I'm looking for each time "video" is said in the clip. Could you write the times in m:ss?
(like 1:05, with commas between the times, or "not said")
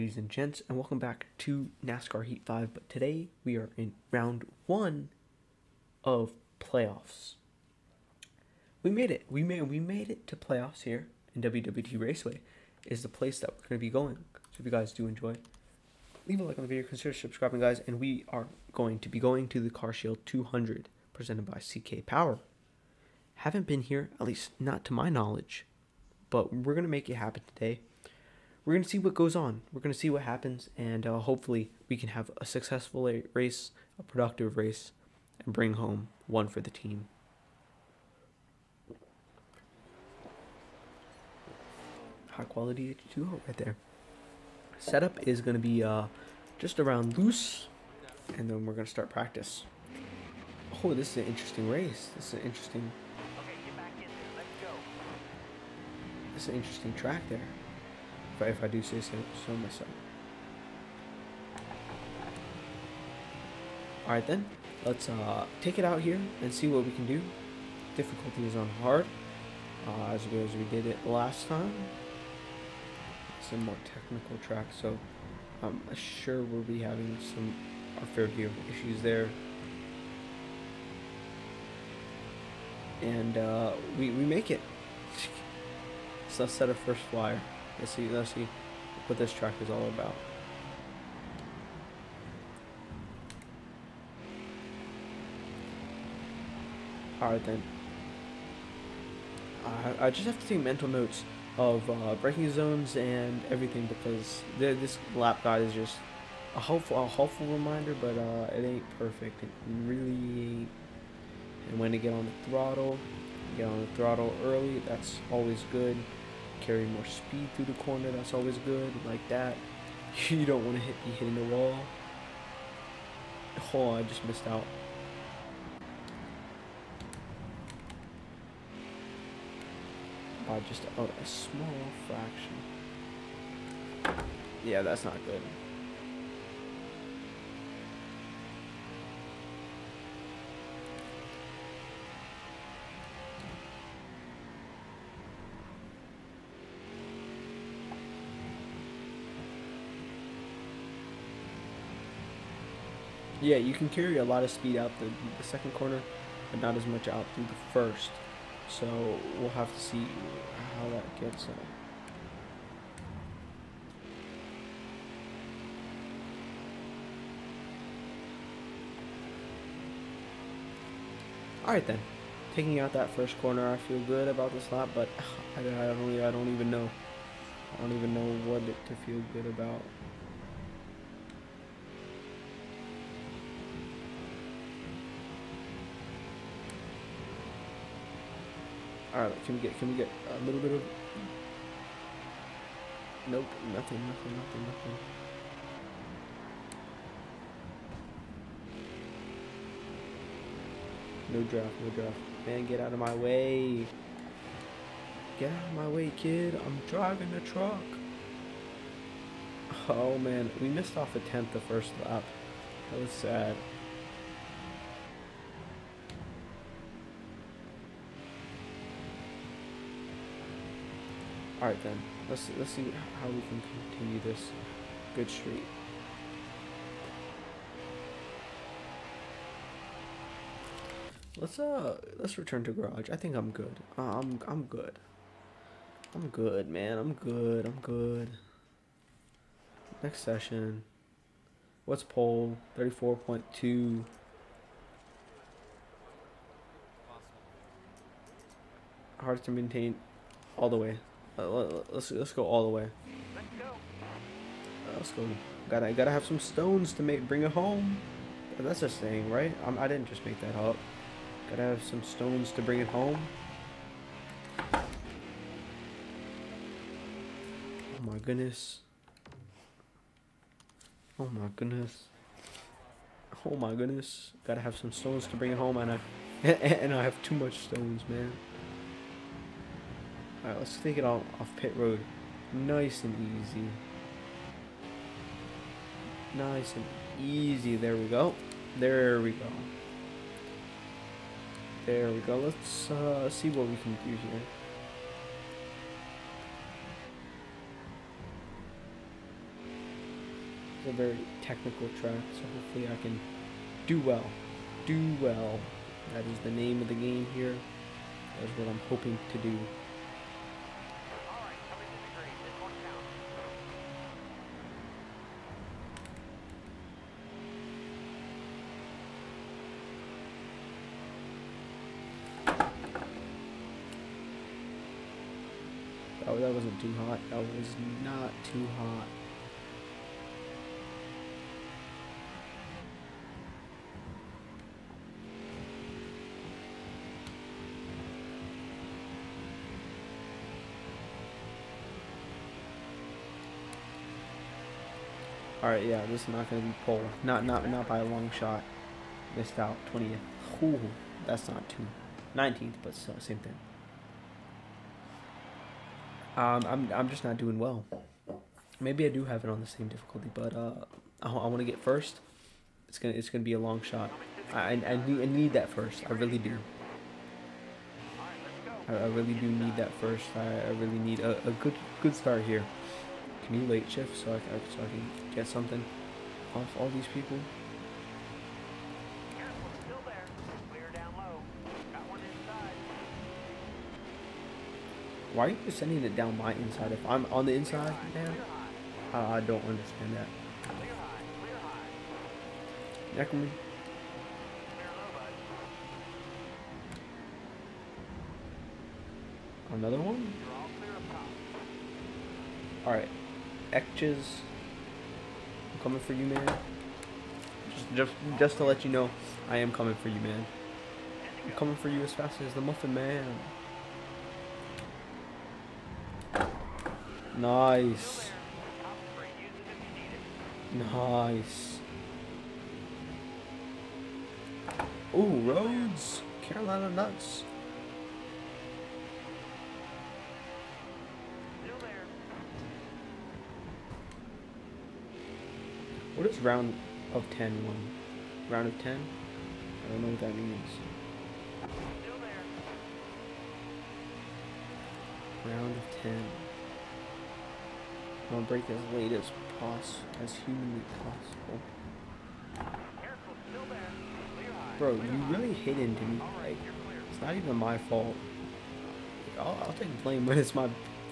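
0:16.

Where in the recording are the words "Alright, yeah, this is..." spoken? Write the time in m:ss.
5:45.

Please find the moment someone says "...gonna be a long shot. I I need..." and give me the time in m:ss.
6:03.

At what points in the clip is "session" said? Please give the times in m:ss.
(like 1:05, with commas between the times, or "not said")
4:00.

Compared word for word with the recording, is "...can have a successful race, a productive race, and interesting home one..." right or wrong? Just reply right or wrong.
wrong.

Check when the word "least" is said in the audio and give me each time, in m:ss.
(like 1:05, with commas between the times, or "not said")
0:24.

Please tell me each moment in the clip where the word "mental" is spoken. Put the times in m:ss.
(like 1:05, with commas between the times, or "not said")
1:40.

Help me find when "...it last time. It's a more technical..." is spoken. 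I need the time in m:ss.
1:10.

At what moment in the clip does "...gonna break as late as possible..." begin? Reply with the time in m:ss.
7:28.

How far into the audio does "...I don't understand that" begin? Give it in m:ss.
6:29.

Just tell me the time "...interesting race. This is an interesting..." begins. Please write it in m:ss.
0:51.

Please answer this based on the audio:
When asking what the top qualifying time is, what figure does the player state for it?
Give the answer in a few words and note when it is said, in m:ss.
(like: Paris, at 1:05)
34.2, at 4:02.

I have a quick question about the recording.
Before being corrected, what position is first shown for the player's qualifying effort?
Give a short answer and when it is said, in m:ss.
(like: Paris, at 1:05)
20th, at 5:49.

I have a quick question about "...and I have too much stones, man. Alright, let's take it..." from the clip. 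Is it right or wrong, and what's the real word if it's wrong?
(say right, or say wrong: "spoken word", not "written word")
right.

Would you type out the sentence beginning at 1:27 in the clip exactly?
Let's see, let's see what this track is all about.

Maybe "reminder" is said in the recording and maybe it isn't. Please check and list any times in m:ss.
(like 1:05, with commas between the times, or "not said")
1:47.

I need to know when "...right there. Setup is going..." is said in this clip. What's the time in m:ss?
0:43.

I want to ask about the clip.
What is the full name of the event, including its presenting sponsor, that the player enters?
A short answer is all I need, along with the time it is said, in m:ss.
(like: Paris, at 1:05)
Car Shield 200 presented by CK Power, at 0:19.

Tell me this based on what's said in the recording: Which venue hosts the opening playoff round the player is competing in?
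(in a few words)
WWT Raceway.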